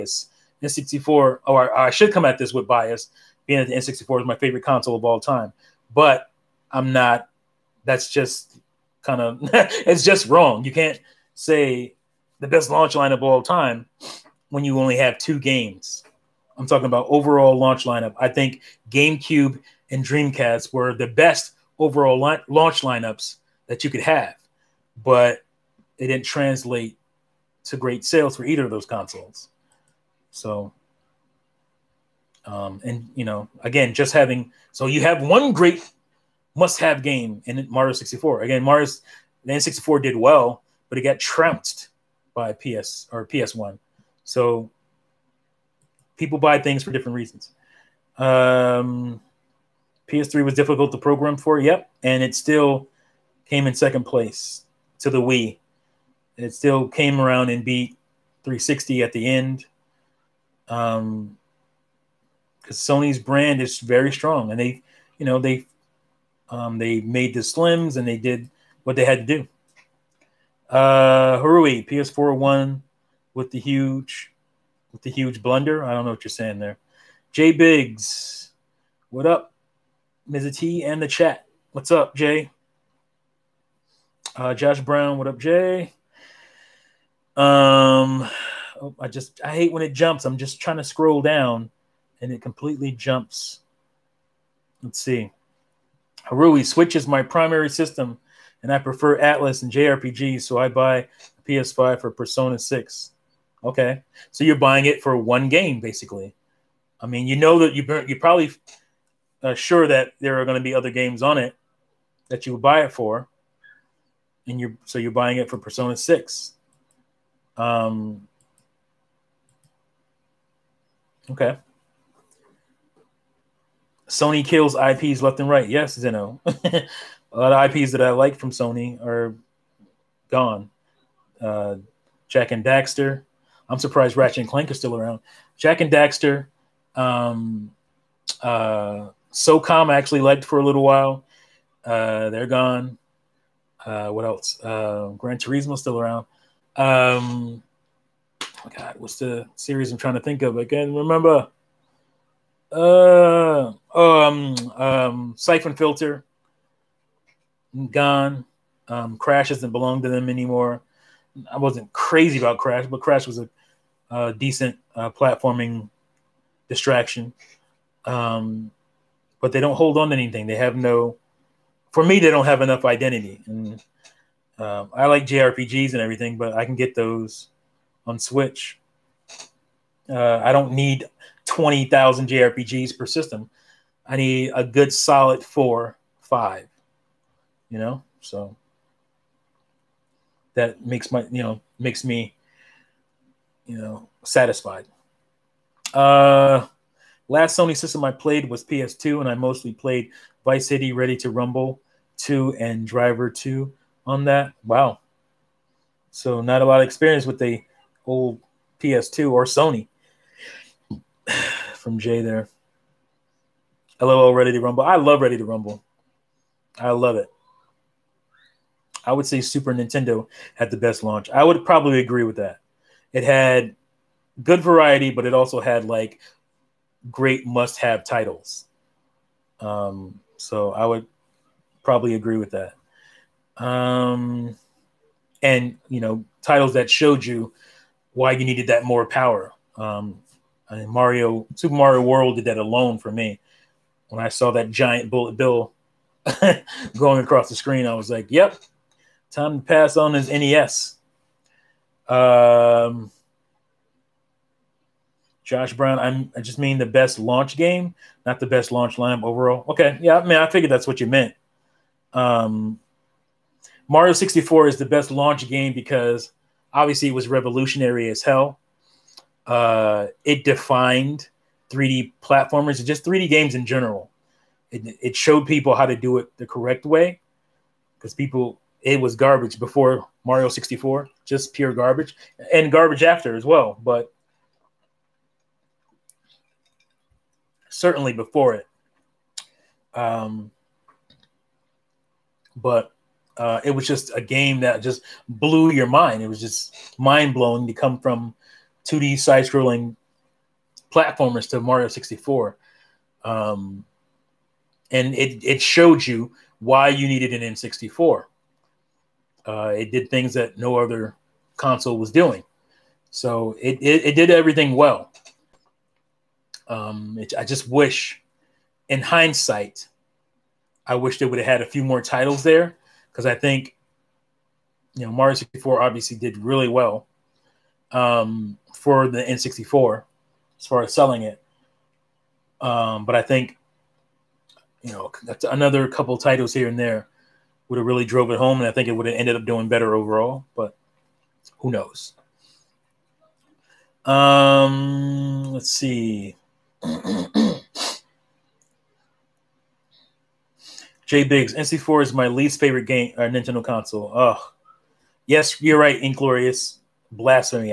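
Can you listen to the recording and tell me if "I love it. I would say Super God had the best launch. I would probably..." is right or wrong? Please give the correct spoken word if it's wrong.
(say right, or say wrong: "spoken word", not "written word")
wrong: "Nintendo", not "God".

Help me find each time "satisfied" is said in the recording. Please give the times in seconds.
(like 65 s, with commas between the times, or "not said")
194 s.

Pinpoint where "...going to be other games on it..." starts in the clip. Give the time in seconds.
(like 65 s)
110 s.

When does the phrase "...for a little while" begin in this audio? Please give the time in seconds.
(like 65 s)
140 s.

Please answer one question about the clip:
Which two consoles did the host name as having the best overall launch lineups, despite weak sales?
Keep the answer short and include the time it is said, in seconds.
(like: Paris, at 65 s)
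GameCube and Dreamcast, at 18 s.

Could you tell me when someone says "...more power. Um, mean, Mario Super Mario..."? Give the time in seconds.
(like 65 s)
238 s.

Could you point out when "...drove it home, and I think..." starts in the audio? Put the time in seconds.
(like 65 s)
338 s.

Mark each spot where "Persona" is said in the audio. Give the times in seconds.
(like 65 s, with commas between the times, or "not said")
102 s, 115 s.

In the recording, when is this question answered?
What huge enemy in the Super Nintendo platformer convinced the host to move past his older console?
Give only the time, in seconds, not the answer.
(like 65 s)
245 s.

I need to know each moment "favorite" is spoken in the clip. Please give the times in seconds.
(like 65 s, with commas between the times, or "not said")
4 s, 352 s.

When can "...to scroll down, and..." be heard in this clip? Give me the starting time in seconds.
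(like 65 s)
90 s.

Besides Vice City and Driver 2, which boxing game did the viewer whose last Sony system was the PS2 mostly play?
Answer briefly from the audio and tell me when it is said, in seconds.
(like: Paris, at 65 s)
Ready to Rumble 2, at 200 s.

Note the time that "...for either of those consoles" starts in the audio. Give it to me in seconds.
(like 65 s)
28 s.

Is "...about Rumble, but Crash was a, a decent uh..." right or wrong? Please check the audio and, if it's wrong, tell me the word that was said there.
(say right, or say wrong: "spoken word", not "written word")
wrong: "Crash", not "Rumble".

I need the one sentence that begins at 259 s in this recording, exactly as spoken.
Okay, yeah, I mean, I figured that's what you meant.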